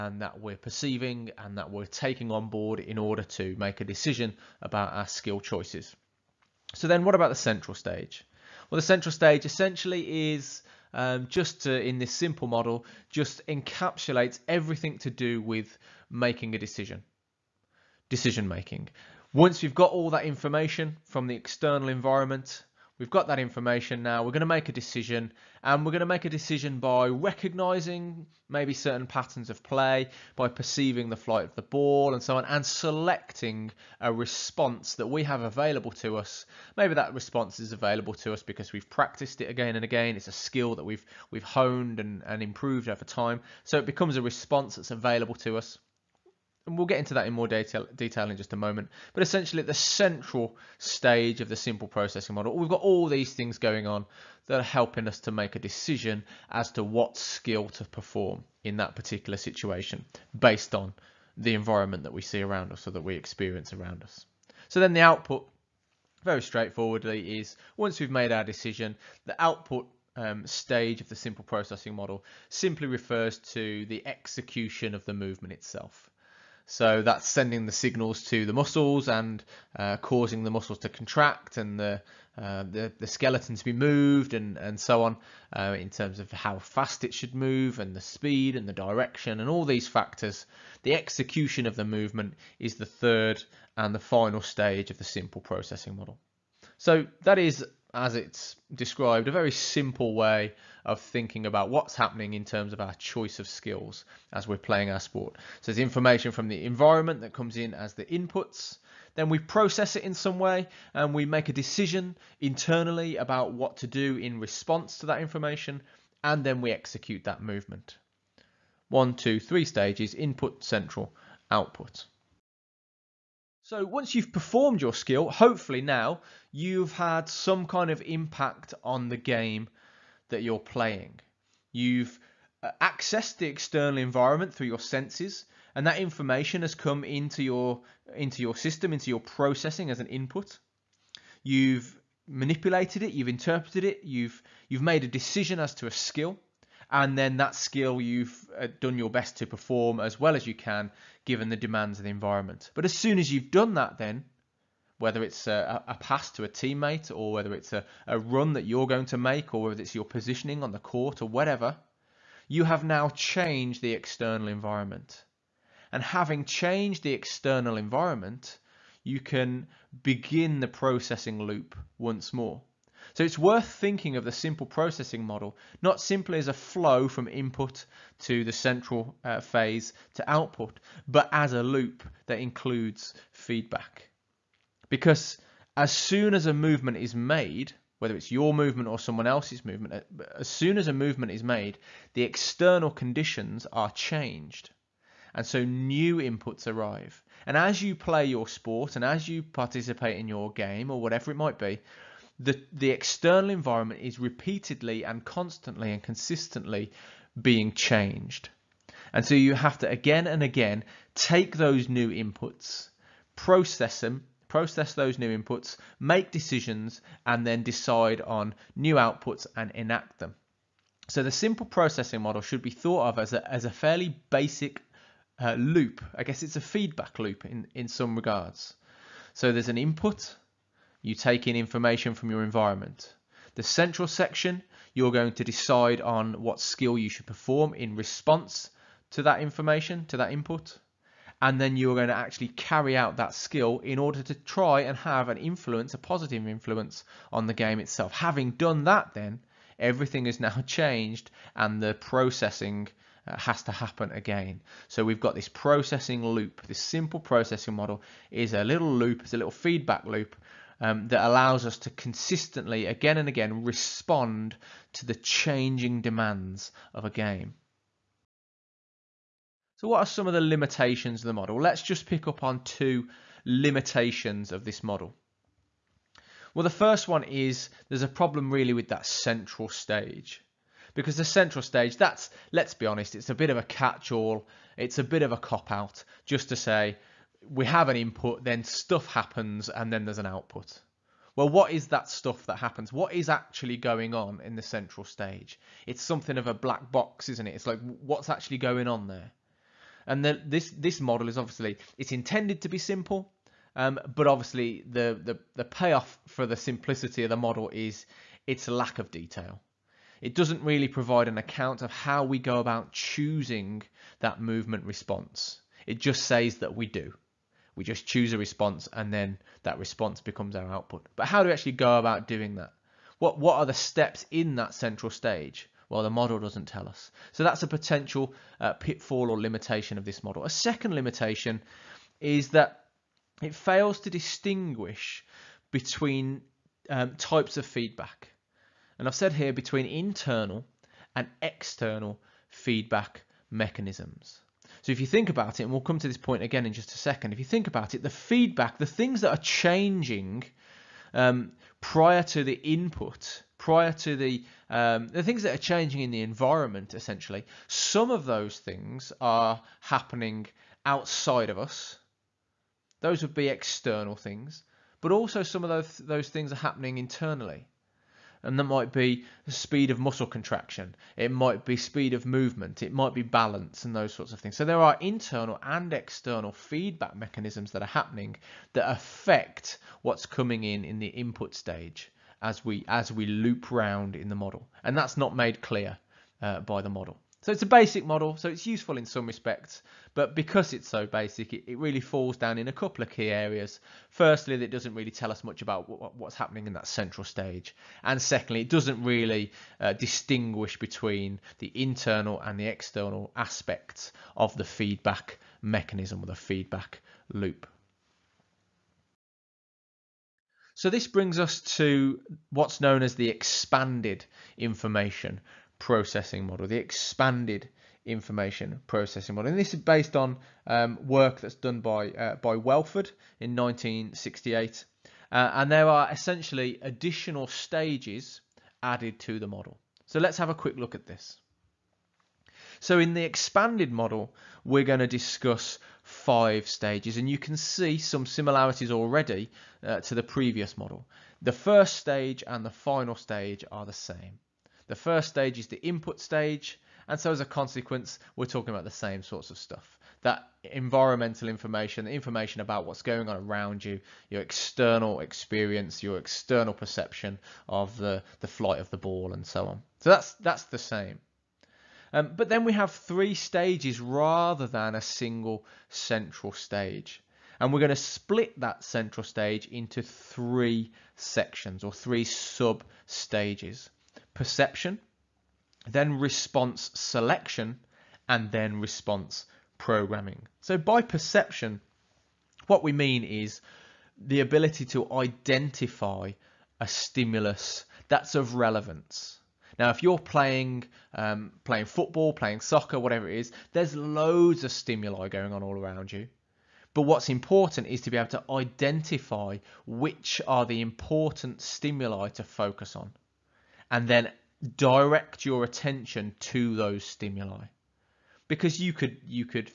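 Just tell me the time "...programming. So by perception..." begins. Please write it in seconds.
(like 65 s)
479 s.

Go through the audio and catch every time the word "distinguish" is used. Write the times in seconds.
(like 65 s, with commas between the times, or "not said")
334 s, 399 s.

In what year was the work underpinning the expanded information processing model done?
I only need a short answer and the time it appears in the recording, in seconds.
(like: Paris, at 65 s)
1968, at 423 s.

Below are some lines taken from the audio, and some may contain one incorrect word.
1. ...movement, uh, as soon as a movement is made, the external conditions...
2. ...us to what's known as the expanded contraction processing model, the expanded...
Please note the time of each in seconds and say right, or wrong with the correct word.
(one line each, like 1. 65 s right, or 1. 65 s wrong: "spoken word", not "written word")
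1. 189 s right
2. 411 s wrong: "information", not "contraction".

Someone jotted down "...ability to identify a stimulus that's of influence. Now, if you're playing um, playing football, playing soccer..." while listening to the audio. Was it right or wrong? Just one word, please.
wrong.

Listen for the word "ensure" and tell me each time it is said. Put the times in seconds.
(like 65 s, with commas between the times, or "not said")
not said.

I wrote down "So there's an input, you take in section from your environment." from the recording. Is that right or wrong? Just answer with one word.
wrong.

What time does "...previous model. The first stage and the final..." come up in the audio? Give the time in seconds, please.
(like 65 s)
440 s.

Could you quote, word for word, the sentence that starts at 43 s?
So it becomes a response that's available to us and we'll get into that in more detail, detail in just a moment.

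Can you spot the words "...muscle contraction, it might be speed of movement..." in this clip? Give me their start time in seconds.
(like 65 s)
369 s.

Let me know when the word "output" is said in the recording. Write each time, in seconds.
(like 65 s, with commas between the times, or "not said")
65 s, 69 s, 121 s, 180 s, 218 s, 290 s, 320 s.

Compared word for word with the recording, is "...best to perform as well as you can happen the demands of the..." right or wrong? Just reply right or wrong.
wrong.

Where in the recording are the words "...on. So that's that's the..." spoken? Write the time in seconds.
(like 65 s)
459 s.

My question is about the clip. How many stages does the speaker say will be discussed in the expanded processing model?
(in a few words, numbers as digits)
5.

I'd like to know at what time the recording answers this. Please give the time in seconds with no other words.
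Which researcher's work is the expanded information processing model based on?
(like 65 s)
422 s.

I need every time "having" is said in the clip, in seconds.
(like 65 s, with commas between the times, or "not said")
166 s, 248 s.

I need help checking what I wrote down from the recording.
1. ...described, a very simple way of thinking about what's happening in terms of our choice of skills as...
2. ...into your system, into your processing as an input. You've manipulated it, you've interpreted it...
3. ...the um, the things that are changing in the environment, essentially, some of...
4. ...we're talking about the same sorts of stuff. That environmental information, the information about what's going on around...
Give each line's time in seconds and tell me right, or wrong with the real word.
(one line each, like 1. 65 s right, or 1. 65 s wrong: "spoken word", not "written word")
1. 98 s right
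2. 138 s right
3. 354 s right
4. 448 s right.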